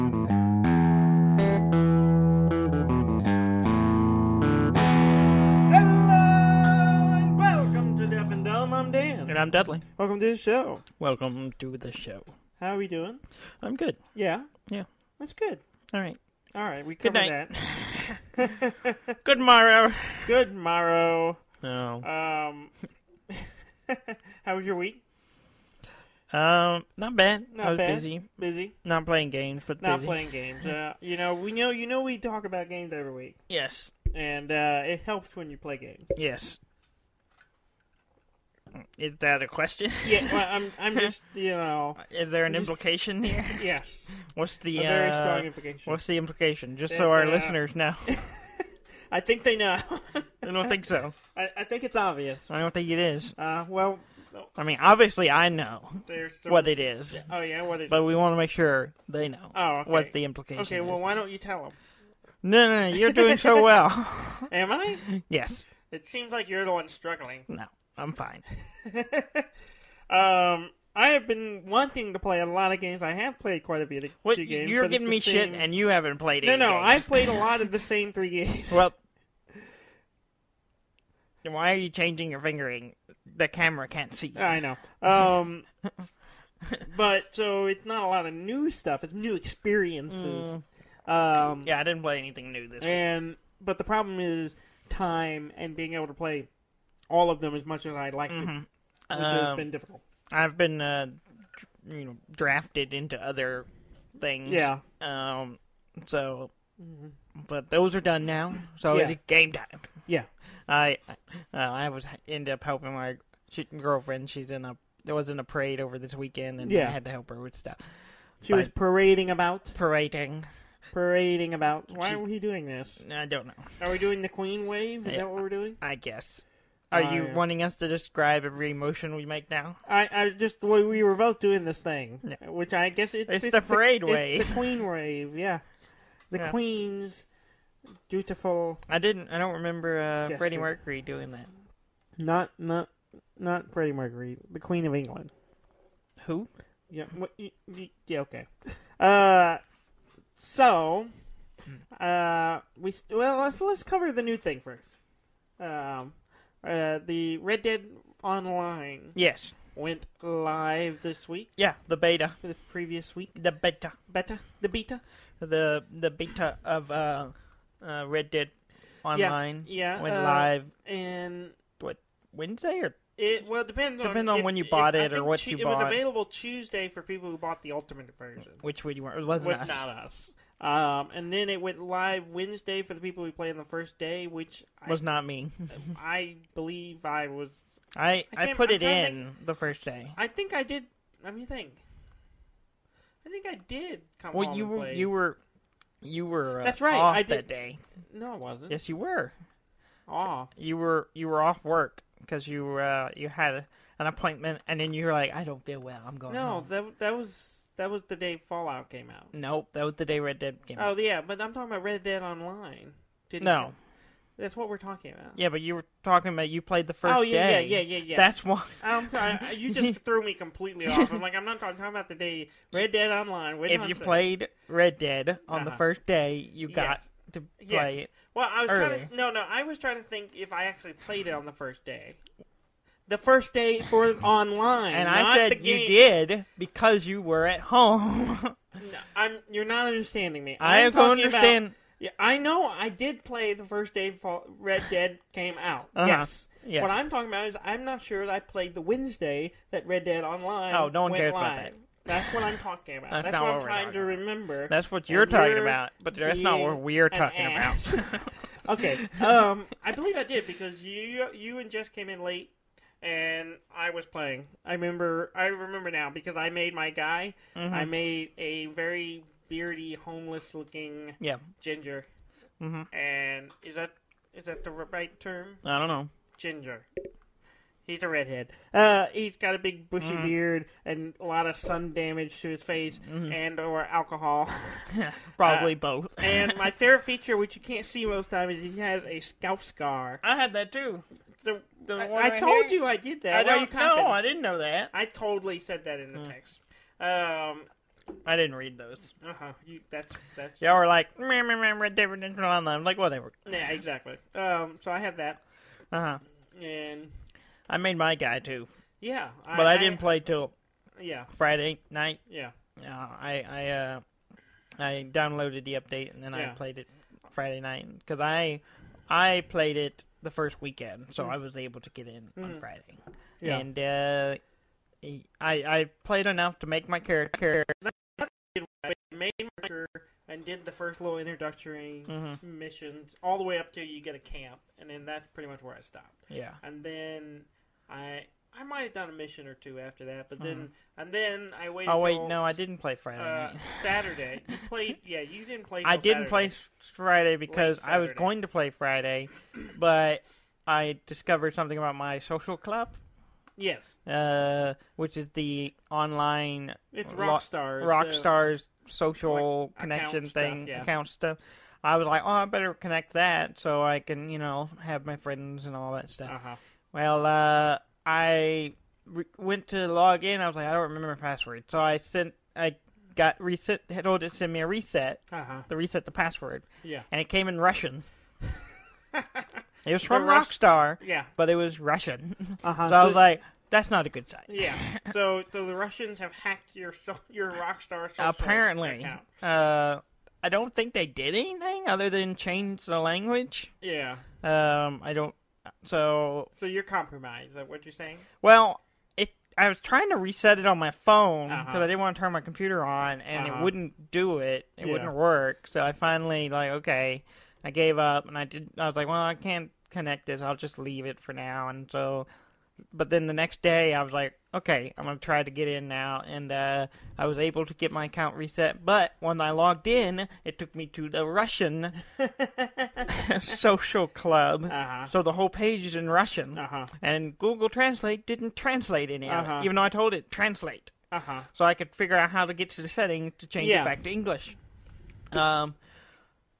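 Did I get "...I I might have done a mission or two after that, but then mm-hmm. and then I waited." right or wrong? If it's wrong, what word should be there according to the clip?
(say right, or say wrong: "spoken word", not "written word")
right.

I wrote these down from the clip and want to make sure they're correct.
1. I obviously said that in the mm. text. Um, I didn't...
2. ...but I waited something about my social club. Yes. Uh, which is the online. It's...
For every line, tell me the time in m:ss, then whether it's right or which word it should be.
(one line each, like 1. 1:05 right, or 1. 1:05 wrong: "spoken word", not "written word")
1. 4:54 wrong: "totally", not "obviously"
2. 5:49 wrong: "discovered", not "waited".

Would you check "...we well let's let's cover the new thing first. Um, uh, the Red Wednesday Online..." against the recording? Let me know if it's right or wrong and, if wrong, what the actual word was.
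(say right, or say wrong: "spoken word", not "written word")
wrong: "Dead", not "Wednesday".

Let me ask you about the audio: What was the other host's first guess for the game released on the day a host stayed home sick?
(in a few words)
Fallout.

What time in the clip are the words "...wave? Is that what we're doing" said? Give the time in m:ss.
2:04.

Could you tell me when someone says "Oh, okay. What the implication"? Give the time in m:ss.
0:59.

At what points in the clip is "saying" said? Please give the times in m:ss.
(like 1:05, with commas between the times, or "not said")
3:43, 6:37.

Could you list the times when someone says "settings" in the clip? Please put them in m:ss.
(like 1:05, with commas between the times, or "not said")
7:12.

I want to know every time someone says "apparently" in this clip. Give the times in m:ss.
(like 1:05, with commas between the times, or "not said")
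6:28.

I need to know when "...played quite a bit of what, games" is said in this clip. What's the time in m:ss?
1:13.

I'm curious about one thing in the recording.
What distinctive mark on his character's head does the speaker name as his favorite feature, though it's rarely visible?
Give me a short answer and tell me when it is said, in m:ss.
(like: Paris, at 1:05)
scalp scar, at 4:49.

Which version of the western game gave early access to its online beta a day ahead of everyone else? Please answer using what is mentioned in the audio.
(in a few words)
Ultimate version.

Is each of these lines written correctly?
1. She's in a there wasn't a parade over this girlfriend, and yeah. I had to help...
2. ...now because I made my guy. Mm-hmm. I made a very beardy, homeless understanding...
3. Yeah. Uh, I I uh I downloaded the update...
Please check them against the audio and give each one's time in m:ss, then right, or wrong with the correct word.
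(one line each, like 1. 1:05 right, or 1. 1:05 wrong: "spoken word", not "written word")
1. 1:54 wrong: "weekend", not "girlfriend"
2. 4:25 wrong: "looking", not "understanding"
3. 5:12 right.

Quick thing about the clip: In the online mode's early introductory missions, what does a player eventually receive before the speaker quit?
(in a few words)
a camp.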